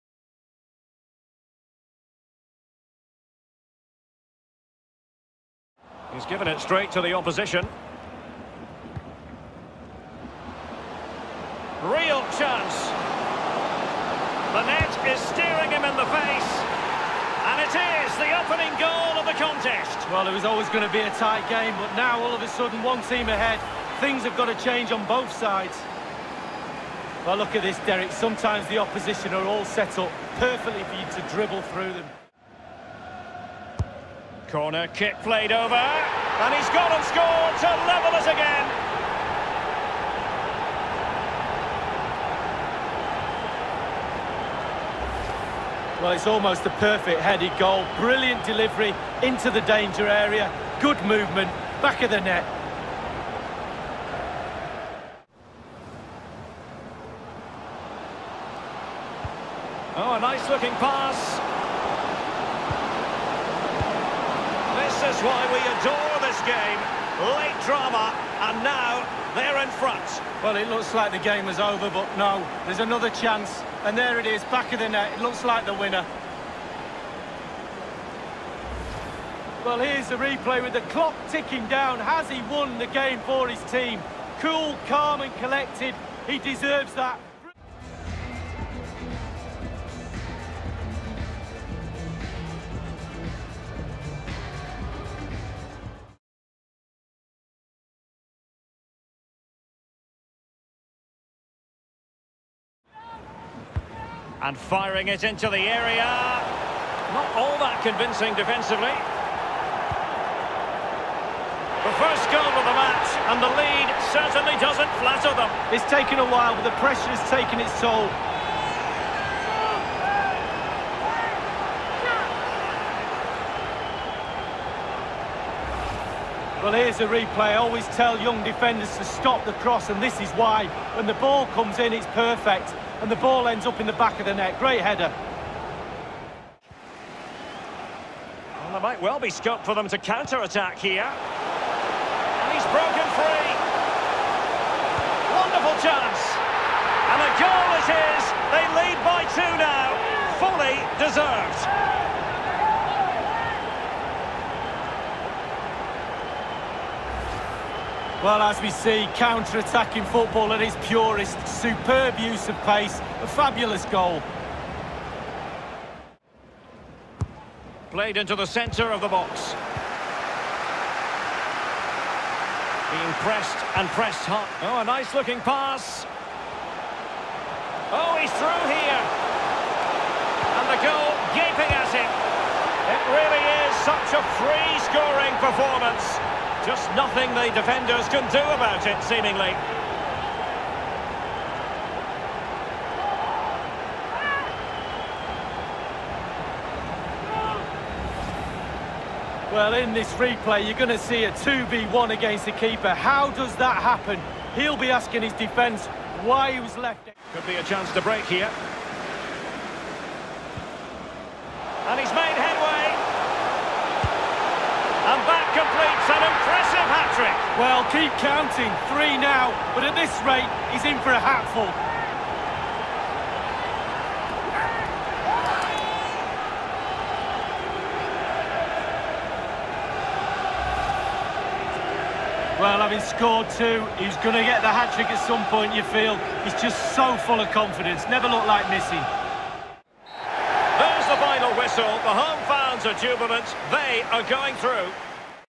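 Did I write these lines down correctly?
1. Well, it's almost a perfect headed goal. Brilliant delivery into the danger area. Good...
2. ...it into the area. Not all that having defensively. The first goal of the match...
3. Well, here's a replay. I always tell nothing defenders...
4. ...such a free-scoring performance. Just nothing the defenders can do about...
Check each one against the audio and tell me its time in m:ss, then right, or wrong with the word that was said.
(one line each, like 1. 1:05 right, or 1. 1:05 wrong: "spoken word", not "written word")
1. 0:46 right
2. 1:45 wrong: "convincing", not "having"
3. 2:06 wrong: "young", not "nothing"
4. 3:03 right.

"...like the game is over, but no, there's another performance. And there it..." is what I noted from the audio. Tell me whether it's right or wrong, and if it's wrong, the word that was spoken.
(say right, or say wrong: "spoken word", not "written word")
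wrong: "chance", not "performance".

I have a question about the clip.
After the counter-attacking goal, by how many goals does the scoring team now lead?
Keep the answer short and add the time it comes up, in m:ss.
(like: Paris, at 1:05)
2, at 2:28.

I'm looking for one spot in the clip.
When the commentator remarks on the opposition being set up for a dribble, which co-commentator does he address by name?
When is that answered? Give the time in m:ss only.
0:27.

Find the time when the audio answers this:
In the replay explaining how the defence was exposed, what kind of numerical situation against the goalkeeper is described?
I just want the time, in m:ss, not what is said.
3:21.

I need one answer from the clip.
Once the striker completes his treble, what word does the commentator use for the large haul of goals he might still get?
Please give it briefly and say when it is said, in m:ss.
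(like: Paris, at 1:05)
hatful, at 3:41.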